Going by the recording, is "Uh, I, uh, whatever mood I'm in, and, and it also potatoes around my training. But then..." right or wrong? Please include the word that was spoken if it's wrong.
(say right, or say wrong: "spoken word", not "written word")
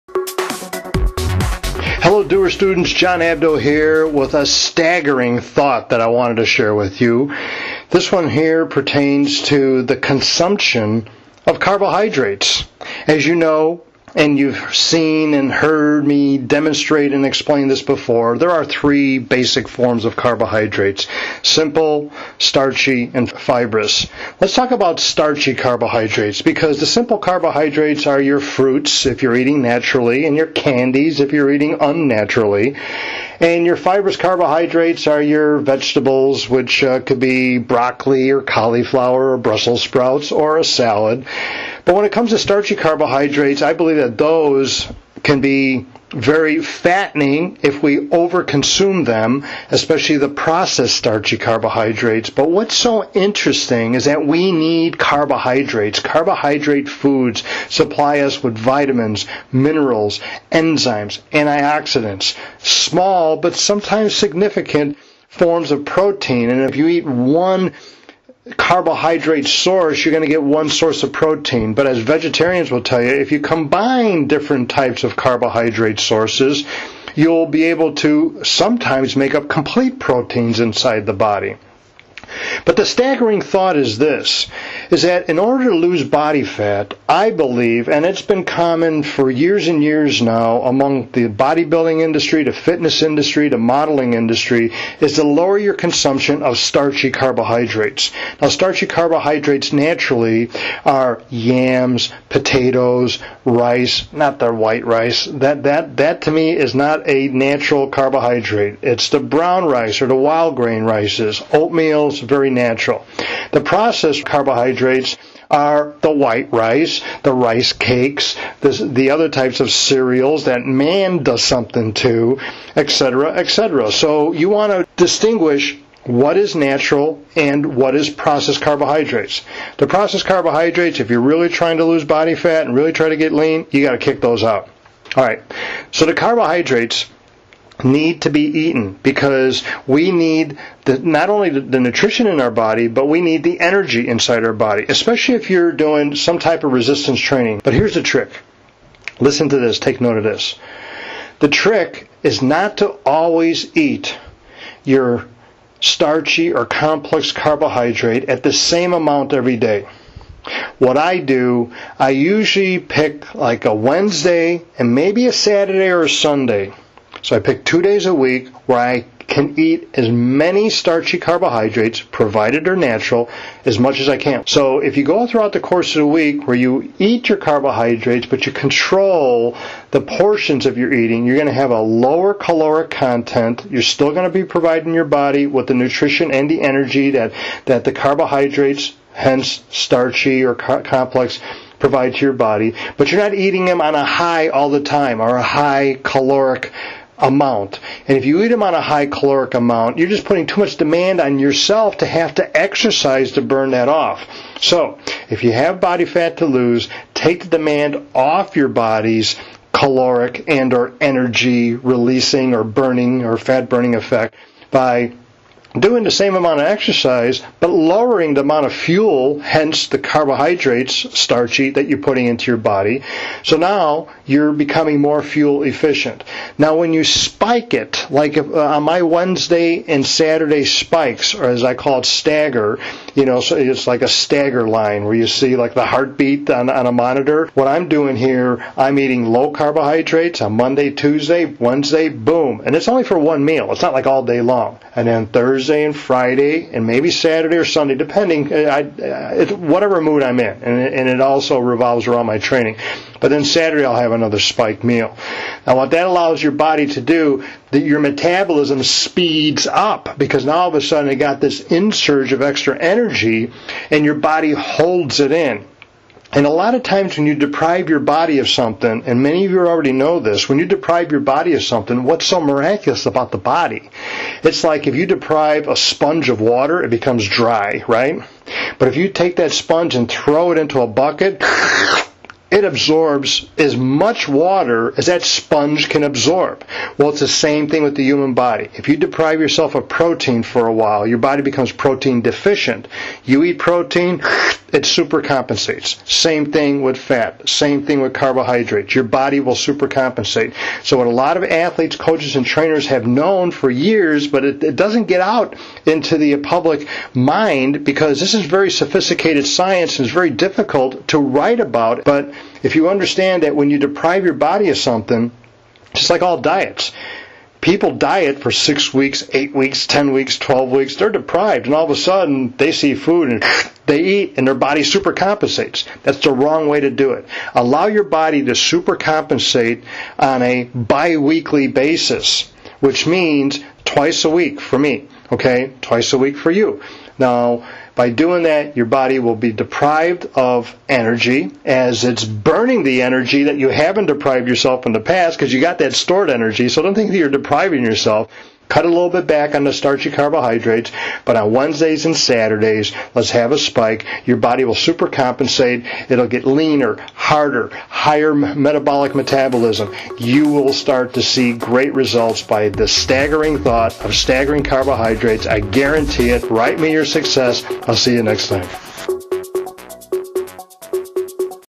wrong: "revolves", not "potatoes".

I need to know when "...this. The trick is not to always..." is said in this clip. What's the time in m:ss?
2:30.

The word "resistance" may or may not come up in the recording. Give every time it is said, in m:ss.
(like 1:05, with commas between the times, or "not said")
2:26.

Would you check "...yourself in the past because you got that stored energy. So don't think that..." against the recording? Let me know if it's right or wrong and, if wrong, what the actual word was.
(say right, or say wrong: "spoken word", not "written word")
right.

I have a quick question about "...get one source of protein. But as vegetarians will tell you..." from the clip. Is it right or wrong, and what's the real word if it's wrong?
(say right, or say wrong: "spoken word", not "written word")
right.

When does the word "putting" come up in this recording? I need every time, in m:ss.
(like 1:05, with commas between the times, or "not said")
3:20, 3:41.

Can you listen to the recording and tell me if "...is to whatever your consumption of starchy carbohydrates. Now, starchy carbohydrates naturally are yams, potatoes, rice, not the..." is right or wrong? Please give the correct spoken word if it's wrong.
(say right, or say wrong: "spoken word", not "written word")
wrong: "lower", not "whatever".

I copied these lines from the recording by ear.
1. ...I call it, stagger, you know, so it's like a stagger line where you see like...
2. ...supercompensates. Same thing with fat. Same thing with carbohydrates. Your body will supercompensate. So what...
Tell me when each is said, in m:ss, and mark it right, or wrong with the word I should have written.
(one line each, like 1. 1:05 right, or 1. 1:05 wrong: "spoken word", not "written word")
1. 3:51 right
2. 4:54 right.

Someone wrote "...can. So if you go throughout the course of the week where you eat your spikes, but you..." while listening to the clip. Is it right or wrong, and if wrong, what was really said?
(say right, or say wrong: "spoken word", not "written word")
wrong: "carbohydrates", not "spikes".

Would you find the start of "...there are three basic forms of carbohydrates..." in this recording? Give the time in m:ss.
0:18.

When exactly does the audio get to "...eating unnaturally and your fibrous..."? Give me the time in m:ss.
0:31.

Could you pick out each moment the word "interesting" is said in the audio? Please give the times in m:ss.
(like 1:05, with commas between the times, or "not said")
0:53.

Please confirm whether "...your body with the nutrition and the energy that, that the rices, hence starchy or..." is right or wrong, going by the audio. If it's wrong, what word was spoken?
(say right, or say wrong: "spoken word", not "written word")
wrong: "carbohydrates", not "rices".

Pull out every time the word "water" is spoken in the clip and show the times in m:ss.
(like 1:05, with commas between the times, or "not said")
4:36, 4:44.